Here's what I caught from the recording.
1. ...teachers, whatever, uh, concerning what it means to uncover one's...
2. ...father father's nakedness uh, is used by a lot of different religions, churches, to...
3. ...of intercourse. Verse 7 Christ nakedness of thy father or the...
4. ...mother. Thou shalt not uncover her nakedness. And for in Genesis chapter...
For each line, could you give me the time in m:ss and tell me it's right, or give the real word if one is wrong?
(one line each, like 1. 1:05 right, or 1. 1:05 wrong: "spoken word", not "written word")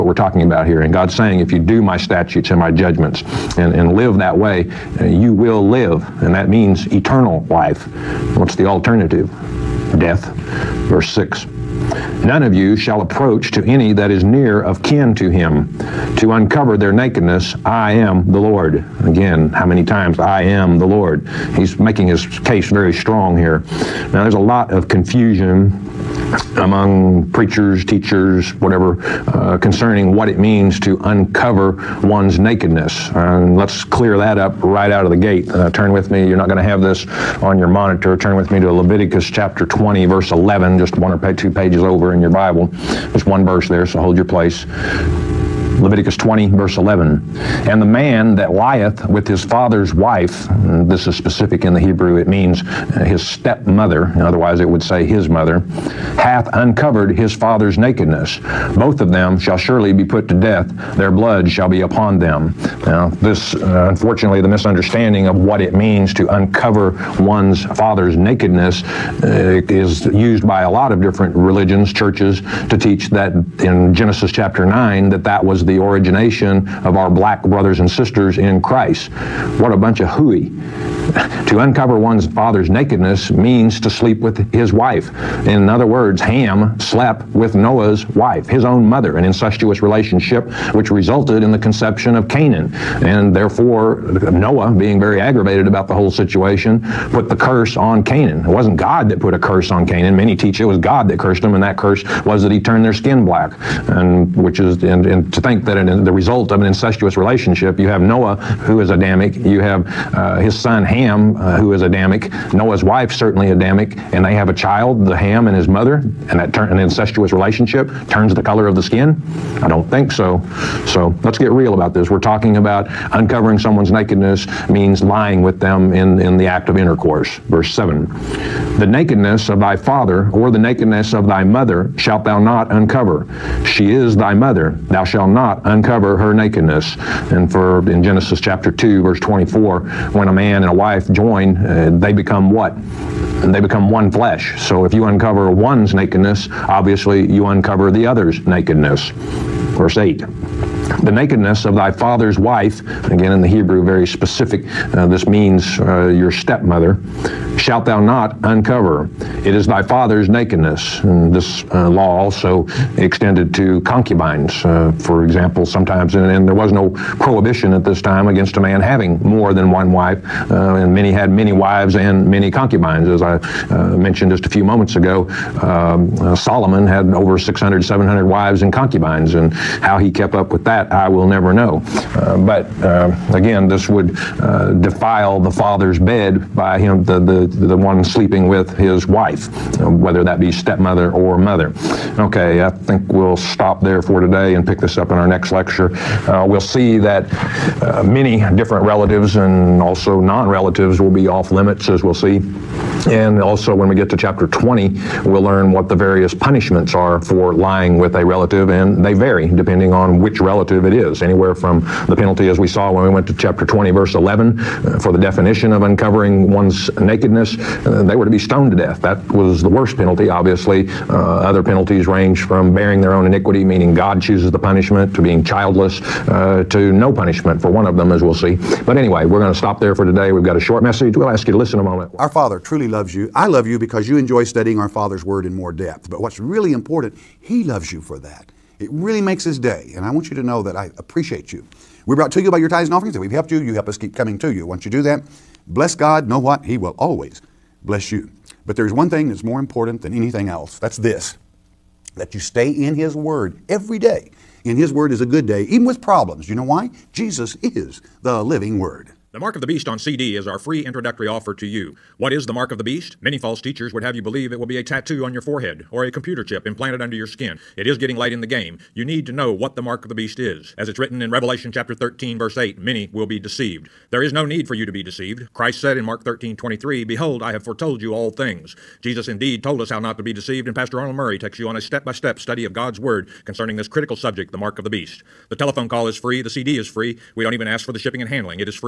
1. 0:27 right
2. 1:07 right
3. 2:06 wrong: "The", not "Christ"
4. 2:14 right.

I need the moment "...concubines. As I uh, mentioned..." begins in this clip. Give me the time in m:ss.
2:52.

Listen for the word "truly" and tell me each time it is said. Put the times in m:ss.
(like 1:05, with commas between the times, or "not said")
3:52.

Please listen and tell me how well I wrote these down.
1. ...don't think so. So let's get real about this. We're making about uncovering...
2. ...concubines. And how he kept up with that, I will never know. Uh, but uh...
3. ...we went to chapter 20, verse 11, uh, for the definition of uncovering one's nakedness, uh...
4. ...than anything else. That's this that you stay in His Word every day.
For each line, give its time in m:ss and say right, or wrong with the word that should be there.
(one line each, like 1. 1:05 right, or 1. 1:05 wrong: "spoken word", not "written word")
1. 1:59 wrong: "talking", not "making"
2. 2:58 right
3. 3:33 right
4. 4:10 right.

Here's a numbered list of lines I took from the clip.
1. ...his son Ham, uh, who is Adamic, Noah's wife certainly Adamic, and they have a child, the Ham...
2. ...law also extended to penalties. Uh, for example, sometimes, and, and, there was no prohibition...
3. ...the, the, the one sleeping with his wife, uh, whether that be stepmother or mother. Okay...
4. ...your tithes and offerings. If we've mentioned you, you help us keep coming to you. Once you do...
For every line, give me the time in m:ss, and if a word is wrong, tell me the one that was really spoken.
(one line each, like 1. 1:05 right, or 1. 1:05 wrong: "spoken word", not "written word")
1. 1:50 right
2. 2:41 wrong: "concubines", not "penalties"
3. 3:07 right
4. 4:02 wrong: "helped", not "mentioned".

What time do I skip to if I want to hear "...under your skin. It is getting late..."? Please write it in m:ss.
4:27.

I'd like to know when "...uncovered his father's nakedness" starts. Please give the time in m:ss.
0:56.